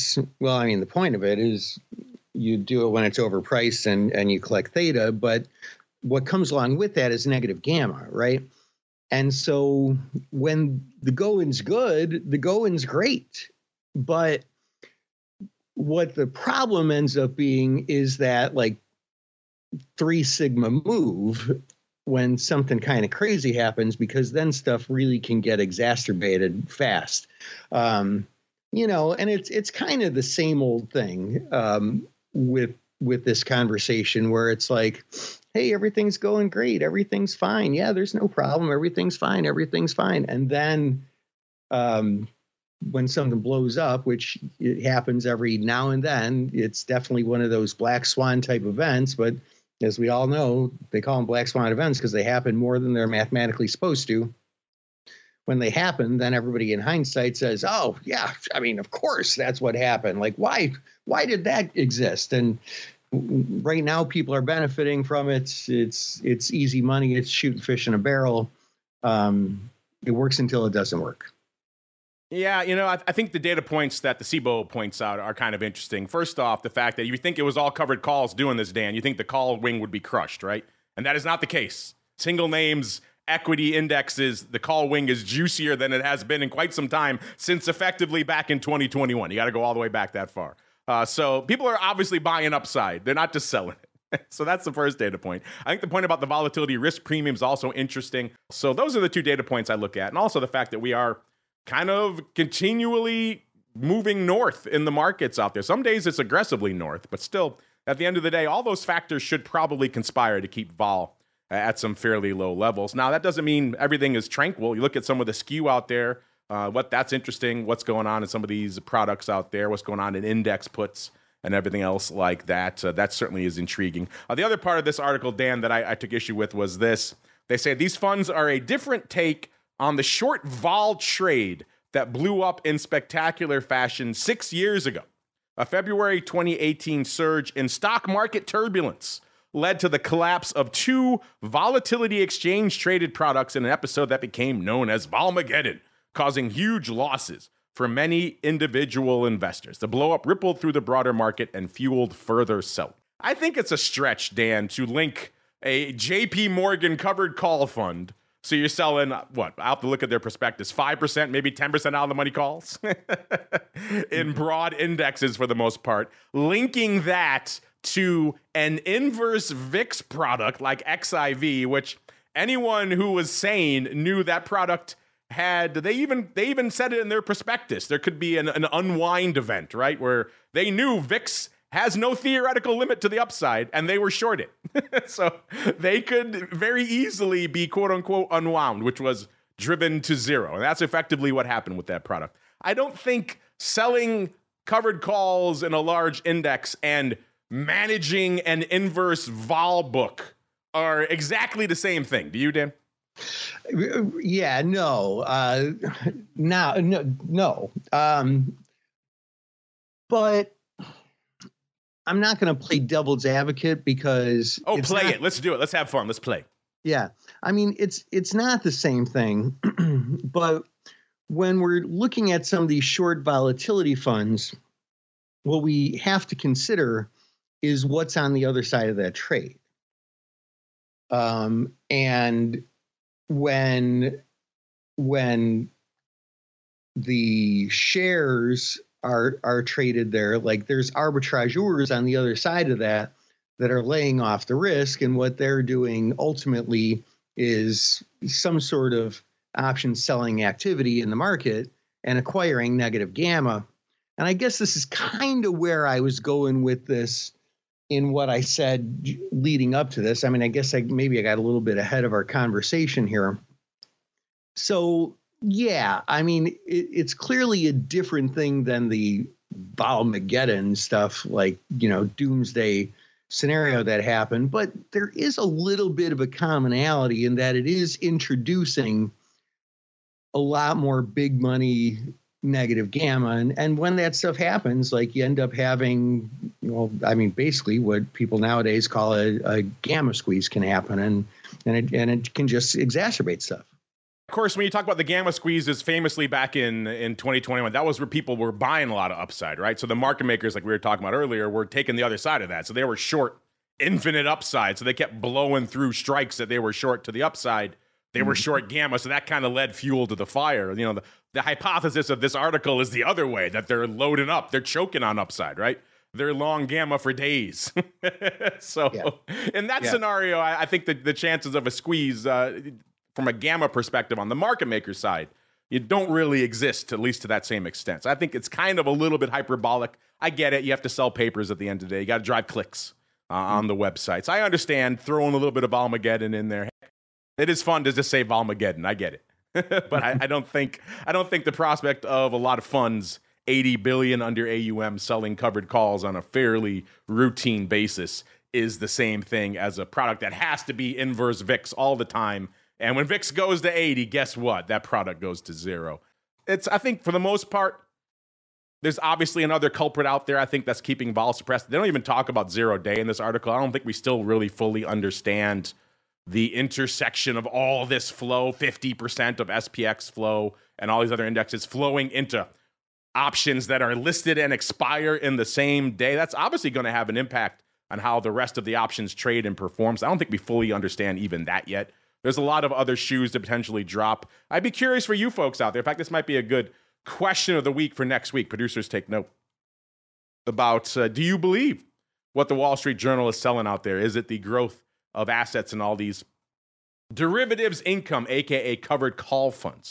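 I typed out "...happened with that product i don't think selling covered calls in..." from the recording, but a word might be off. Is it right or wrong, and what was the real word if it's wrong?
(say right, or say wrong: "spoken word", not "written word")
right.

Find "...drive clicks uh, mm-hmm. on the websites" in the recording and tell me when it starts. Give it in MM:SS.
05:32.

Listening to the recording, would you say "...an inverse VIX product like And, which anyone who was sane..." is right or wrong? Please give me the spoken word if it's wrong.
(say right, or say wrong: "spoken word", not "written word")
wrong: "XIV", not "And".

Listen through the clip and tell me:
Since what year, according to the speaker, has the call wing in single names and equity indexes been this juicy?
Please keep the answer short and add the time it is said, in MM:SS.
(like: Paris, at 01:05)
2021, at 01:28.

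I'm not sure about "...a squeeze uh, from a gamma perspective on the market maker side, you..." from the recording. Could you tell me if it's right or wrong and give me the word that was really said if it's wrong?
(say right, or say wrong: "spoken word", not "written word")
right.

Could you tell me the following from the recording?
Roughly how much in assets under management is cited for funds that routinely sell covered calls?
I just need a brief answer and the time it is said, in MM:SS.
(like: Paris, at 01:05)
80 billion, at 05:43.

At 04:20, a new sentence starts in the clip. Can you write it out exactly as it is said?
I mean, I guess I maybe I got a little bit ahead of our conversation here.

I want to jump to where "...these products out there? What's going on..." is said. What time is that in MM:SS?
01:58.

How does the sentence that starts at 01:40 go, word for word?
And also the fact that we are kind of continually moving north in the markets out there.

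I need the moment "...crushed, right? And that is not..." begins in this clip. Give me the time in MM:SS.
01:20.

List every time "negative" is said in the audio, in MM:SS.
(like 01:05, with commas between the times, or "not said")
00:07, 04:12, 04:42.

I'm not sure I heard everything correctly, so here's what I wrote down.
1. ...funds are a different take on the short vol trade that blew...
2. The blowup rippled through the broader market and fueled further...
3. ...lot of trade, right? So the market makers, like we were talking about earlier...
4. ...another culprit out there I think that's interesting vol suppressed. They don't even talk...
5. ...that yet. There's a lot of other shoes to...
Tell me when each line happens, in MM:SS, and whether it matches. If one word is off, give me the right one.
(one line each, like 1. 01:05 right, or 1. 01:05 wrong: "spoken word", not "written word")
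1. 02:07 right
2. 02:29 right
3. 04:58 wrong: "upside", not "trade"
4. 05:59 wrong: "keeping", not "interesting"
5. 06:21 right.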